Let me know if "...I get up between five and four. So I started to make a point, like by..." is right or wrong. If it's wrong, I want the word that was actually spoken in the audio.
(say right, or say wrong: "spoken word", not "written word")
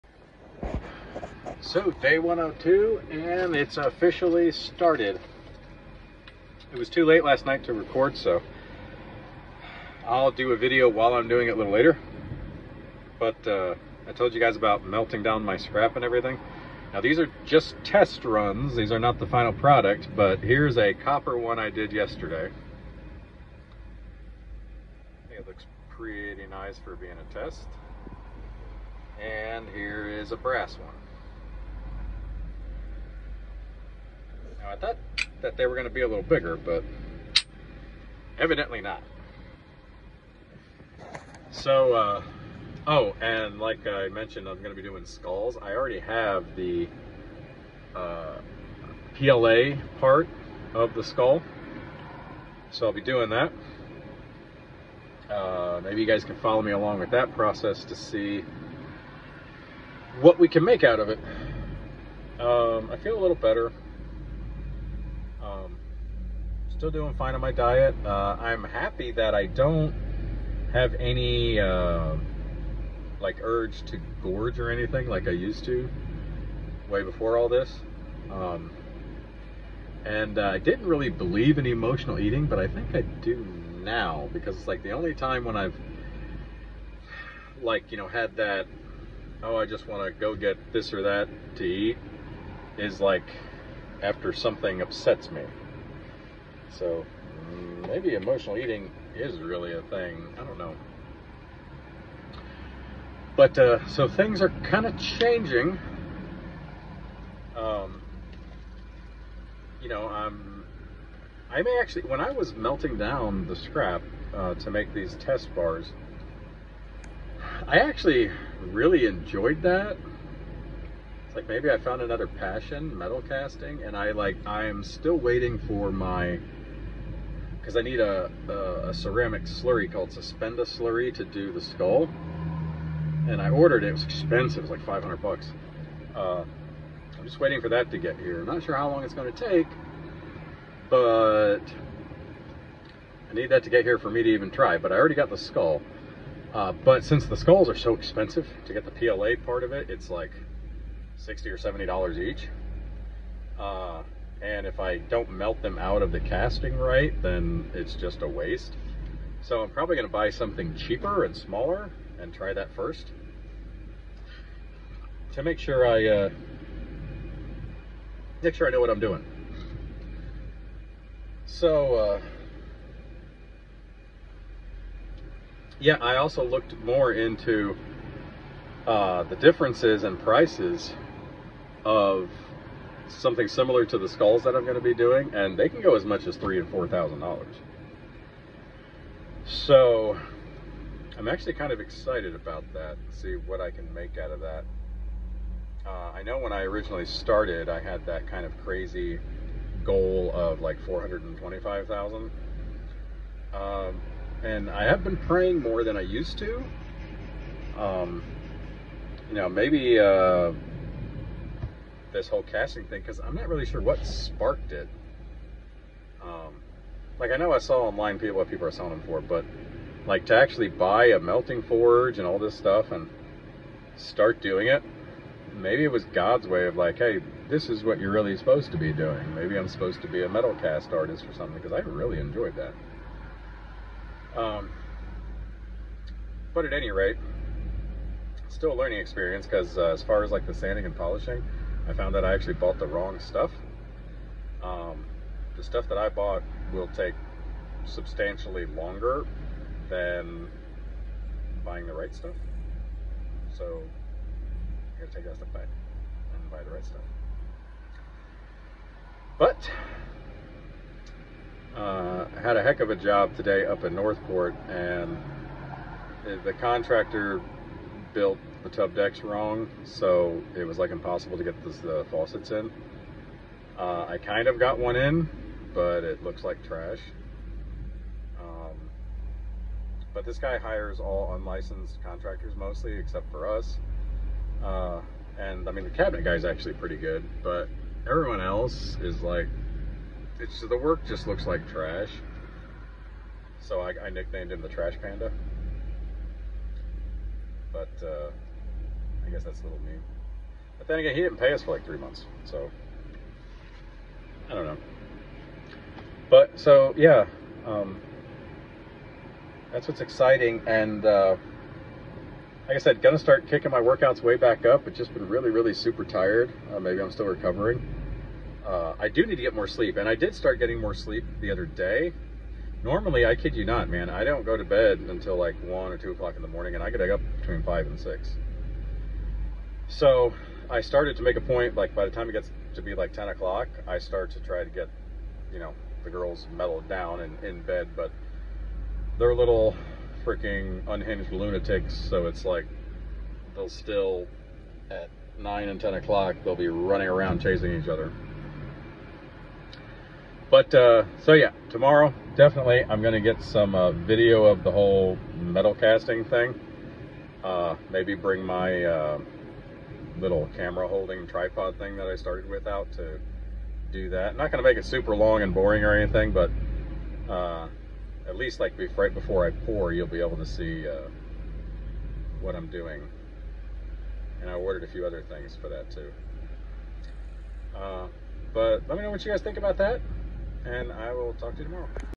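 wrong: "six", not "four".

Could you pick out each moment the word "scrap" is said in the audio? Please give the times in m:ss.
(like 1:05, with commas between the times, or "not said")
0:15, 1:53.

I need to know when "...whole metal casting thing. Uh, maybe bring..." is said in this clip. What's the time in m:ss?
5:54.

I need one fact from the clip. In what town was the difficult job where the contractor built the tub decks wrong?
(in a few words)
Northport.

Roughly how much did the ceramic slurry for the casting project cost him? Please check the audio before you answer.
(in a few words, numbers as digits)
$500.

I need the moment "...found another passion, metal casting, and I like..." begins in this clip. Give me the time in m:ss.
2:01.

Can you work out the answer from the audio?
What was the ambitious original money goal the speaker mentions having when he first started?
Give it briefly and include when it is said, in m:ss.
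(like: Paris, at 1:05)
425,000, at 3:20.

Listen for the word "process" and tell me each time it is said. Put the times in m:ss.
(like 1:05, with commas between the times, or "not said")
0:57.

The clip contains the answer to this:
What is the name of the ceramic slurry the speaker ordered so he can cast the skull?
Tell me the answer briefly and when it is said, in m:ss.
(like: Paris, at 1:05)
Suspenda slurry, at 2:10.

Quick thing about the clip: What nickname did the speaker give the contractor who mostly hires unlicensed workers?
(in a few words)
Trash Panda.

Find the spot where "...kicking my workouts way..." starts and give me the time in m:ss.
5:13.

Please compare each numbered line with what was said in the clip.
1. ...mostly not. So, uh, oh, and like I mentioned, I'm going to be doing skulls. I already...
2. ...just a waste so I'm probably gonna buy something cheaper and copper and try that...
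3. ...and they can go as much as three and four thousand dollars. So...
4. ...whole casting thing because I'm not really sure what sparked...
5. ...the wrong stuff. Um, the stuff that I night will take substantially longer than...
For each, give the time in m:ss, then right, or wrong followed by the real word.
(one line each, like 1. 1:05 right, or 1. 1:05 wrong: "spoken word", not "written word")
1. 0:38 wrong: "evidently", not "mostly"
2. 2:37 wrong: "smaller", not "copper"
3. 3:05 right
4. 3:32 right
5. 4:02 wrong: "bought", not "night".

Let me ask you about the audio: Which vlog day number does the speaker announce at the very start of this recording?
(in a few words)
102.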